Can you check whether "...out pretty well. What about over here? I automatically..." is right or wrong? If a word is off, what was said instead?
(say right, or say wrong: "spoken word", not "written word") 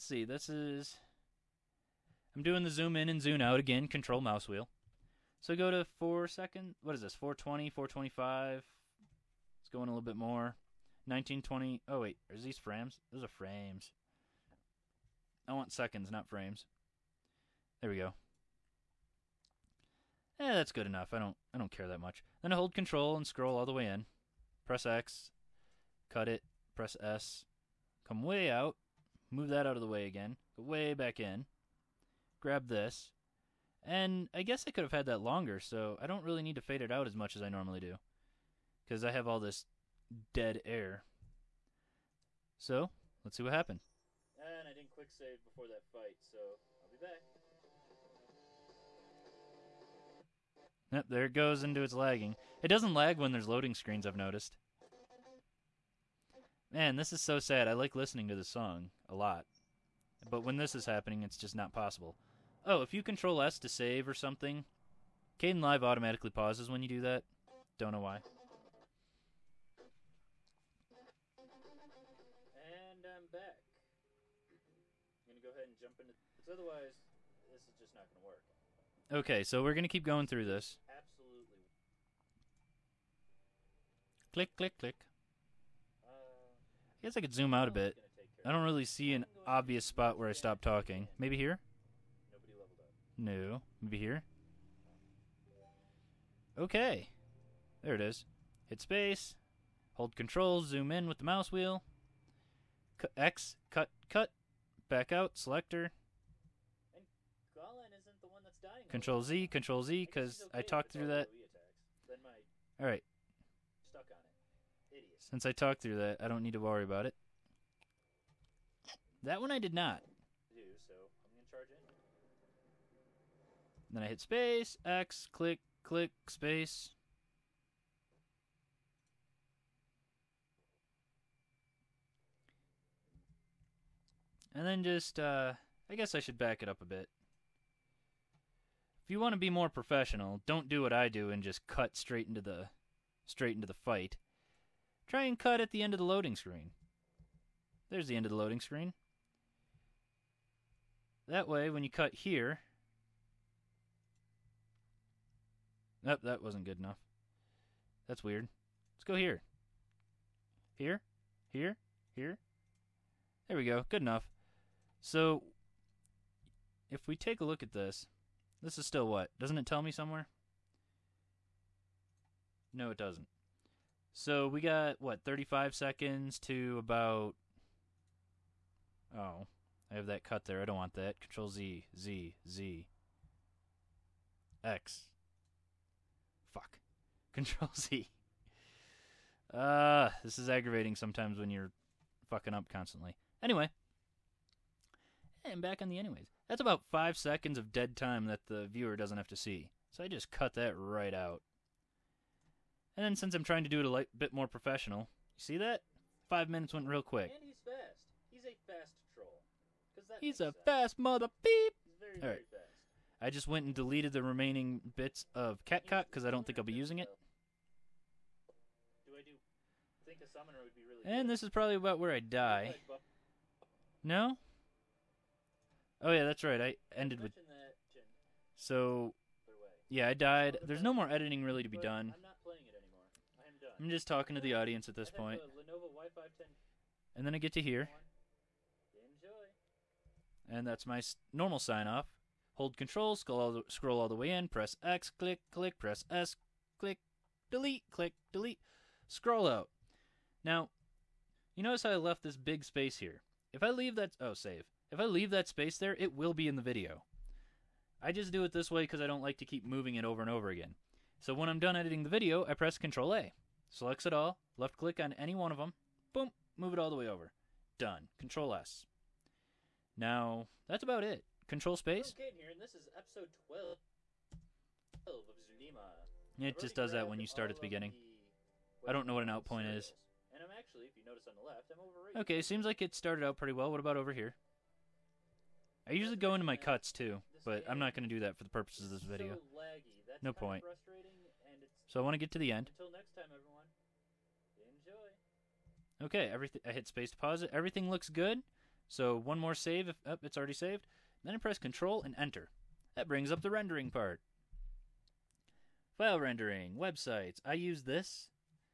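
wrong: "usually", not "automatically".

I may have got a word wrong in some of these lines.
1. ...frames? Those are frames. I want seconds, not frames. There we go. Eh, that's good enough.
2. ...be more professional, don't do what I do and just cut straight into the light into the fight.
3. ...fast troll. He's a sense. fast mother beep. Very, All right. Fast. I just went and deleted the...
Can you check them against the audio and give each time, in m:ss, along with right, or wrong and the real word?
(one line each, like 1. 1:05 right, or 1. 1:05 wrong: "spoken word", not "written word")
1. 0:12 right
2. 2:19 wrong: "straight", not "light"
3. 3:28 right.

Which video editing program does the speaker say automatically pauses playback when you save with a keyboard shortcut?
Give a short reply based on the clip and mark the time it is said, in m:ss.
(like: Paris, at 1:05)
Kdenlive, at 1:05.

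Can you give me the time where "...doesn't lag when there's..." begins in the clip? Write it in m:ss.
0:52.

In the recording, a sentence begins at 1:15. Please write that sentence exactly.
I'm going to go ahead and jump into...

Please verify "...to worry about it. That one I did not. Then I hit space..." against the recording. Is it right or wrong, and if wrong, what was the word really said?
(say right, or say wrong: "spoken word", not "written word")
right.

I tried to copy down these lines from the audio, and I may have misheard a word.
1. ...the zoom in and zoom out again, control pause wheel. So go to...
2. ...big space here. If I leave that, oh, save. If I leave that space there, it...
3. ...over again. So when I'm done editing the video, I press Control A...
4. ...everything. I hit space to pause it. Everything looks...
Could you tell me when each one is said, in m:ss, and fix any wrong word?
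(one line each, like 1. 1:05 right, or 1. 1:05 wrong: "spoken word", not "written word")
1. 0:02 wrong: "mouse", not "pause"
2. 4:12 right
3. 4:20 right
4. 4:56 right.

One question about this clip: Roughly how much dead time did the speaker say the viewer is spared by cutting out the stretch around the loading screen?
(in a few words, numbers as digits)
5 seconds.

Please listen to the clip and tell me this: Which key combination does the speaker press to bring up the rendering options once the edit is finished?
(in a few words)
Control and Enter.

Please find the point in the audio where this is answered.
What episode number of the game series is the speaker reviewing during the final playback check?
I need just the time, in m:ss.
4:32.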